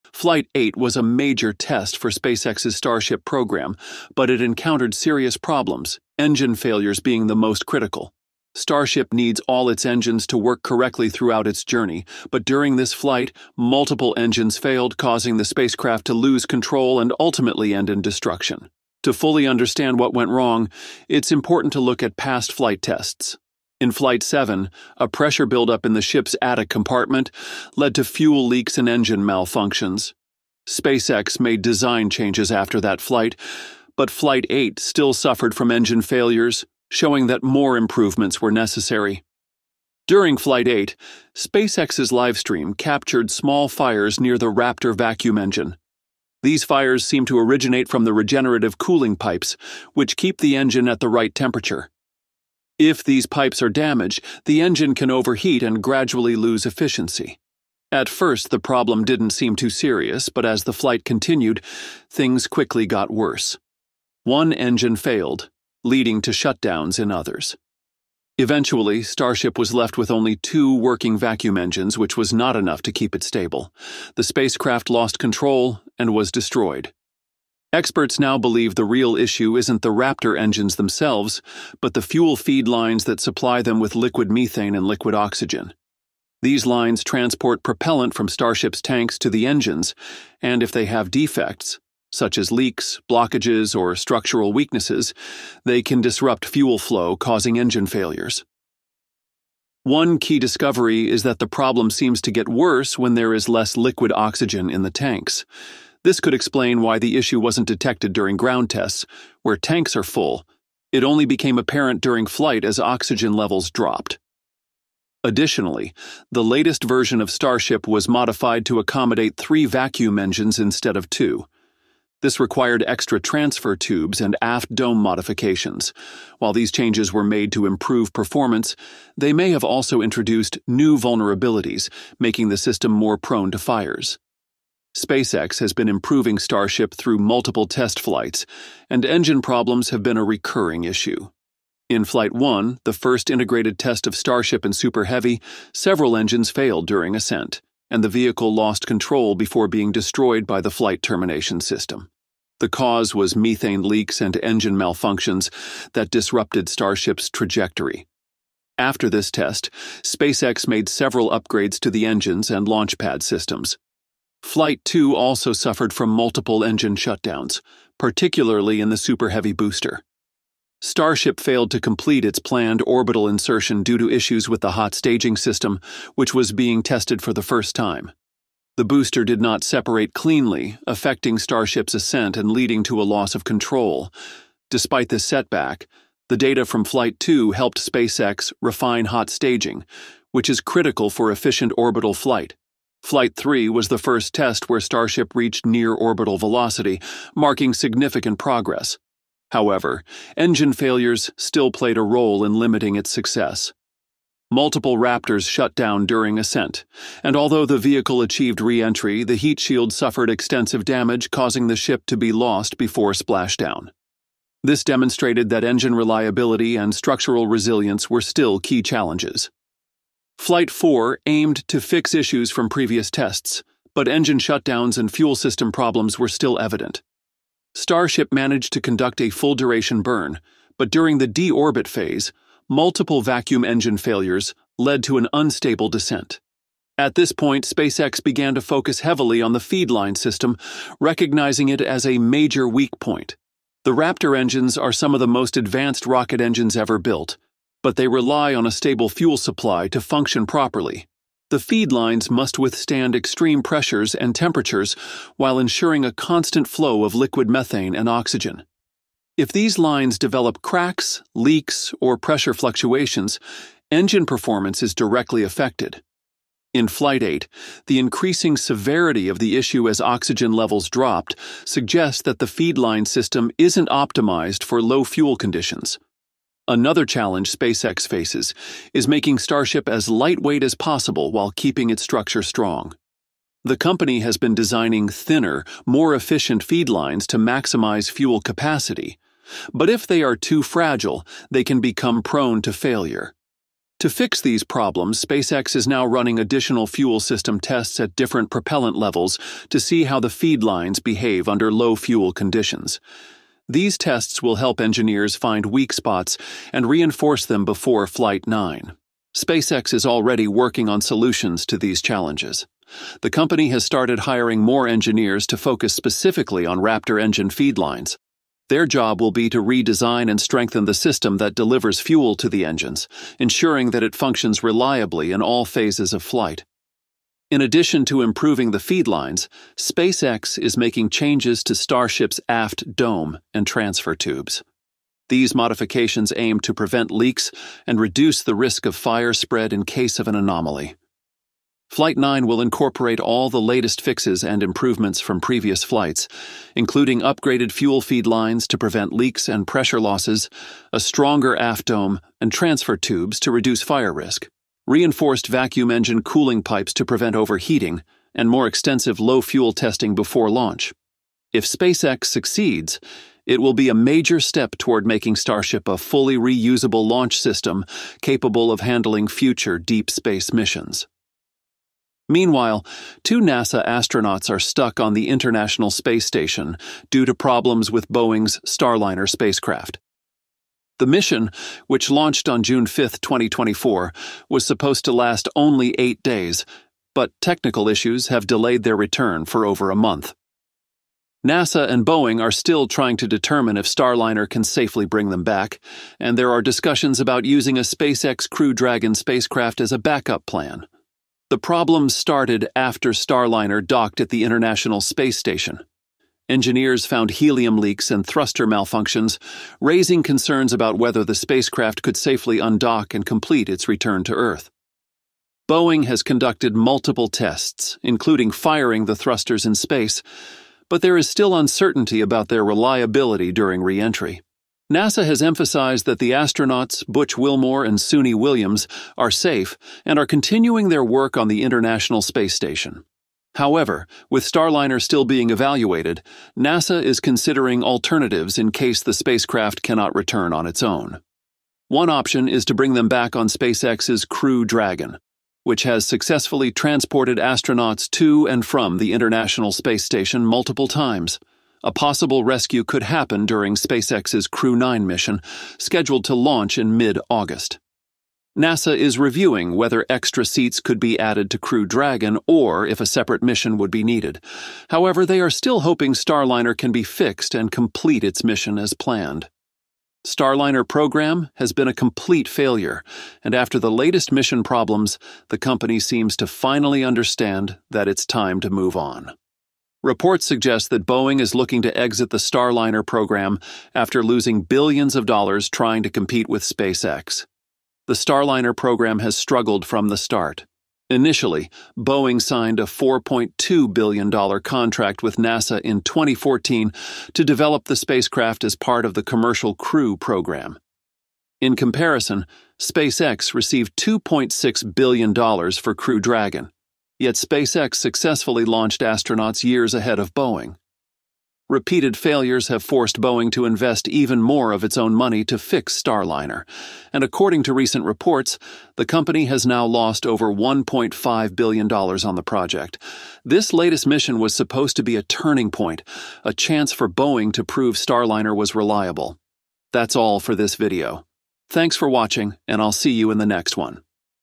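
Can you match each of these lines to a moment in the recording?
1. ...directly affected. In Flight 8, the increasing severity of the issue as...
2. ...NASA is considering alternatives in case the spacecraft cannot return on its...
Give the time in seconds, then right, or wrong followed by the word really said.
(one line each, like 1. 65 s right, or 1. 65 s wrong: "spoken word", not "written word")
1. 264 s right
2. 436 s right.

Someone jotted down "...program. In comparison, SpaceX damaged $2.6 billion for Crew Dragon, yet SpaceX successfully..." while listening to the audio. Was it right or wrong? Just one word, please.
wrong.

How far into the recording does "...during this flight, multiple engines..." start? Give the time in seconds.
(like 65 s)
12 s.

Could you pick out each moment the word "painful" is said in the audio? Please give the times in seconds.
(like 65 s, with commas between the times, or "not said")
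not said.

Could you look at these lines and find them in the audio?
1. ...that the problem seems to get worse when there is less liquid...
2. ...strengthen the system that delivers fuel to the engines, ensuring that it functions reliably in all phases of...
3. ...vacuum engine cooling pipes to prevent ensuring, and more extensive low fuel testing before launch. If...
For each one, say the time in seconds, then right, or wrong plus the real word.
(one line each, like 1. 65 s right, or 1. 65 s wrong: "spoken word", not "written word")
1. 101 s right
2. 320 s right
3. 355 s wrong: "overheating", not "ensuring".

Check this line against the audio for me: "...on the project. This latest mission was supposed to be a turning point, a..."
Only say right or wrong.
right.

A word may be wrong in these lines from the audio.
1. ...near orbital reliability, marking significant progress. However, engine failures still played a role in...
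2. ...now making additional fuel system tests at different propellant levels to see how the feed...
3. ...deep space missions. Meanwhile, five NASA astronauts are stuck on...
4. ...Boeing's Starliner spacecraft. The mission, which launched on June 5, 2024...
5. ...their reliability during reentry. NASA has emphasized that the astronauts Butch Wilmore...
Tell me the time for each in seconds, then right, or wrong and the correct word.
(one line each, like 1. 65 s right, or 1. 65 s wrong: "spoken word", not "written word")
1. 195 s wrong: "velocity", not "reliability"
2. 295 s wrong: "running", not "making"
3. 369 s wrong: "two", not "five"
4. 378 s right
5. 422 s right.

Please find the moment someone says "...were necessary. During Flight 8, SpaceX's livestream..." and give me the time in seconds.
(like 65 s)
38 s.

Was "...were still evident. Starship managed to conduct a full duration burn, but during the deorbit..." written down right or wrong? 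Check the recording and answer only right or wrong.
right.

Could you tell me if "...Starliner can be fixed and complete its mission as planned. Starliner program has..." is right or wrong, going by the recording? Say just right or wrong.
right.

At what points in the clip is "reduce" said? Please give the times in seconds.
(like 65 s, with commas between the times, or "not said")
337 s, 353 s.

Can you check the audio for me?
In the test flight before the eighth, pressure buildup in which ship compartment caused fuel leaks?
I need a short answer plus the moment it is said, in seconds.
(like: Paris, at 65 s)
attic compartment, at 26 s.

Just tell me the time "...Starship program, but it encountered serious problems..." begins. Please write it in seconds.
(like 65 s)
2 s.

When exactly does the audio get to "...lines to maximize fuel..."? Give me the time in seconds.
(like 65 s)
286 s.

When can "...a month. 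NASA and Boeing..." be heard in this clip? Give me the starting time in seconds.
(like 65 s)
389 s.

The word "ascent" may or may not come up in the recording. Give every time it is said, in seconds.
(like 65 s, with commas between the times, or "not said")
147 s, 181 s, 206 s.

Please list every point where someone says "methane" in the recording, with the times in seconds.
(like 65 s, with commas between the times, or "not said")
84 s, 153 s, 257 s.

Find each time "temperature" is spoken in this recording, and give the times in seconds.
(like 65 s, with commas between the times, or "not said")
51 s, 254 s.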